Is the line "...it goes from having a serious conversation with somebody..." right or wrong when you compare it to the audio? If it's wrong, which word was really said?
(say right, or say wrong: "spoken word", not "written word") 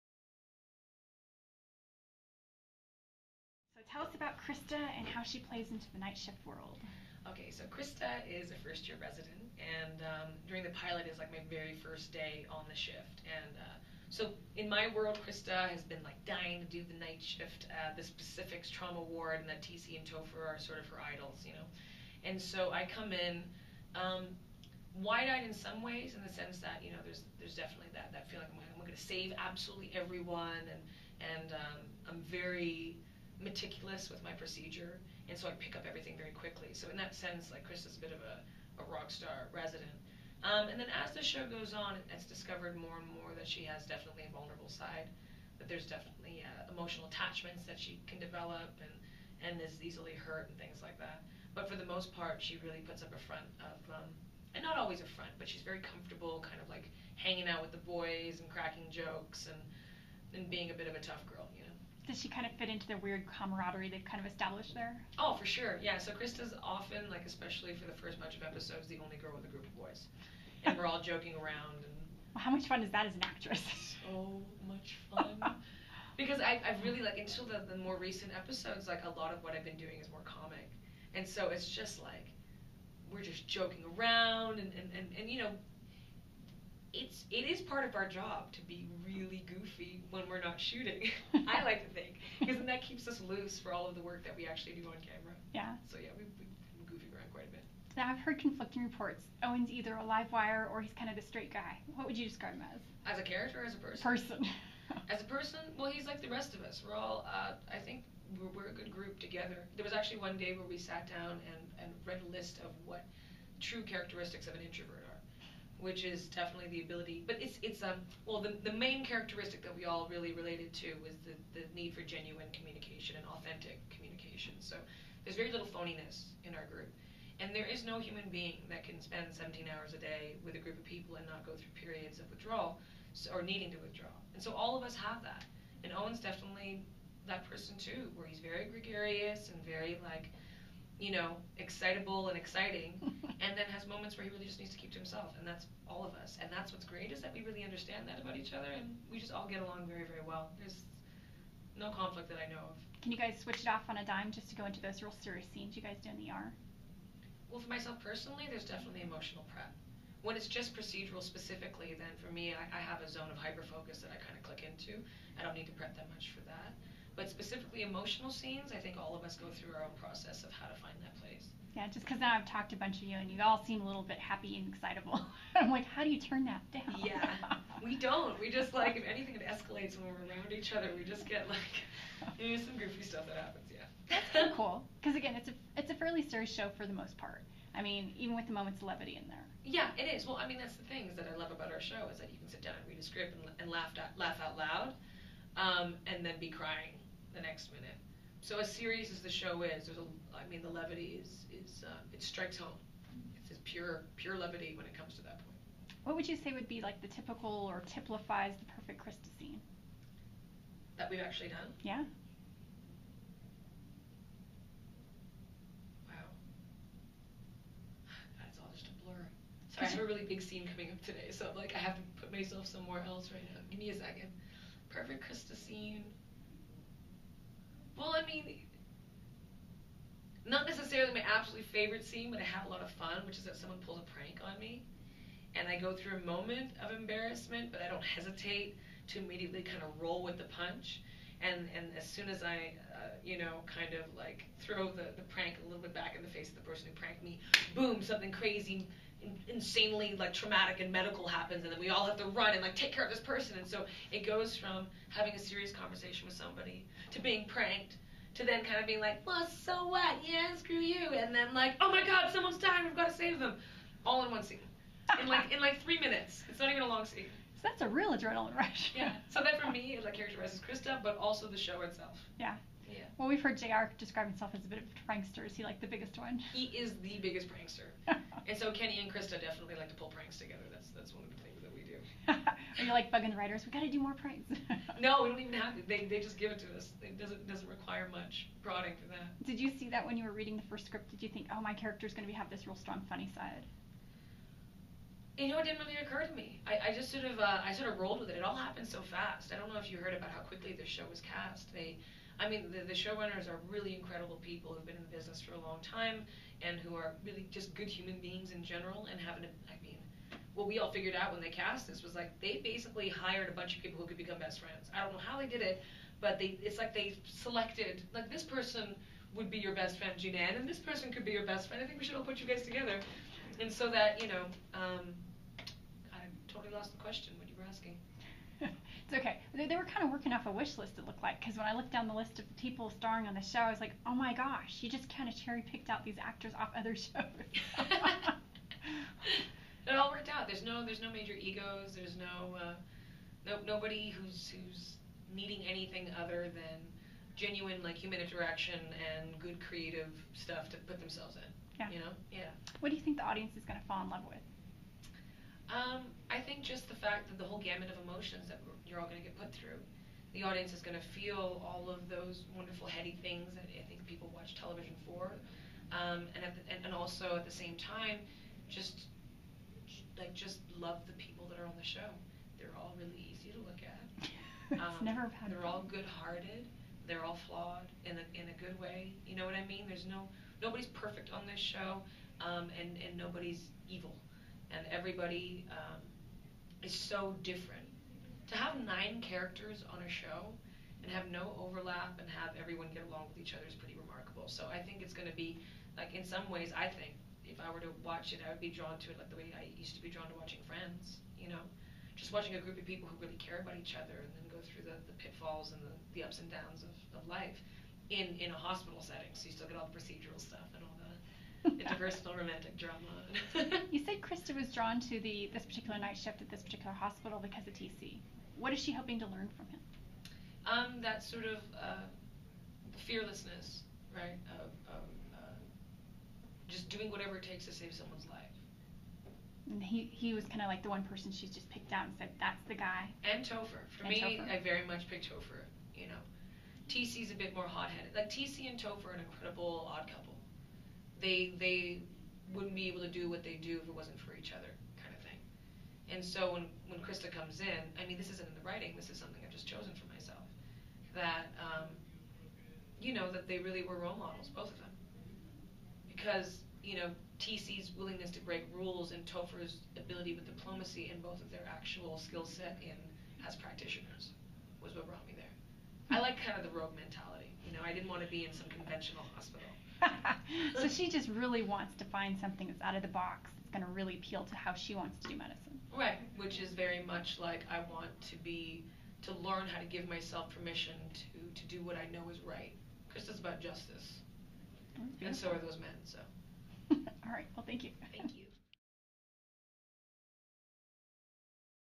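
right.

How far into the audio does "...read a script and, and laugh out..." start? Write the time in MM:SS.
03:12.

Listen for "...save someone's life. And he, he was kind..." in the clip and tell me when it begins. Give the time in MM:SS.
07:07.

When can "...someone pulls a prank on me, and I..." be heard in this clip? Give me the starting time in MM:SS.
03:53.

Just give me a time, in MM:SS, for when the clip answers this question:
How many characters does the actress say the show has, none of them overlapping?
06:28.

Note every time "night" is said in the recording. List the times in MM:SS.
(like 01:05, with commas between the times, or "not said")
00:05, 00:17, 06:55.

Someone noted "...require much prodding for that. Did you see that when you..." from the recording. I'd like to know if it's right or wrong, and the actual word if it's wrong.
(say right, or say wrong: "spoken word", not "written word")
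right.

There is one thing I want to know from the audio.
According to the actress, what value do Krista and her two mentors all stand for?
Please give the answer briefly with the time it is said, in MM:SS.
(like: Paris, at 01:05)
Justice, at 08:03.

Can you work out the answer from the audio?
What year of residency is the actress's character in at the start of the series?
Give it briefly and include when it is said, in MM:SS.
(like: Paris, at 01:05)
First year, at 00:08.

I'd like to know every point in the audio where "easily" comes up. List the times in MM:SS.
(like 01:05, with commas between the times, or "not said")
00:49.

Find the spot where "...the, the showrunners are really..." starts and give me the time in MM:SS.
05:02.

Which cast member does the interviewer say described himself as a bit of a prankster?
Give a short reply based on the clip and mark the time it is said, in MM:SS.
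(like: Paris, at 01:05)
JR, at 04:33.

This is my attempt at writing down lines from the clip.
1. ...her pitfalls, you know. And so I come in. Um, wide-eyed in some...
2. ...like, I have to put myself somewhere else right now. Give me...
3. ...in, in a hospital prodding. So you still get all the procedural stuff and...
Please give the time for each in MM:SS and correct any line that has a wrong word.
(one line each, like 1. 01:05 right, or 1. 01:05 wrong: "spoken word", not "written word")
1. 00:20 wrong: "idols", not "pitfalls"
2. 03:41 right
3. 06:48 wrong: "setting", not "prodding".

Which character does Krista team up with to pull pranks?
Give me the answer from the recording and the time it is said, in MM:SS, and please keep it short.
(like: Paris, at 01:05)
Kenny, at 04:38.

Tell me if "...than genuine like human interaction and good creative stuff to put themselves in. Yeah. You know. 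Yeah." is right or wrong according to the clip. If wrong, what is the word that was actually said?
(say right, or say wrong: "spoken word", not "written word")
right.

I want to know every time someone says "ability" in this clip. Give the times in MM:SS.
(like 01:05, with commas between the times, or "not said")
01:56, 07:39.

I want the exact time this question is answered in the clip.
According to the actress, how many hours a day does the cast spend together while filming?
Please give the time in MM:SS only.
02:09.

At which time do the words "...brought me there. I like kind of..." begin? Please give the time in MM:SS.
07:45.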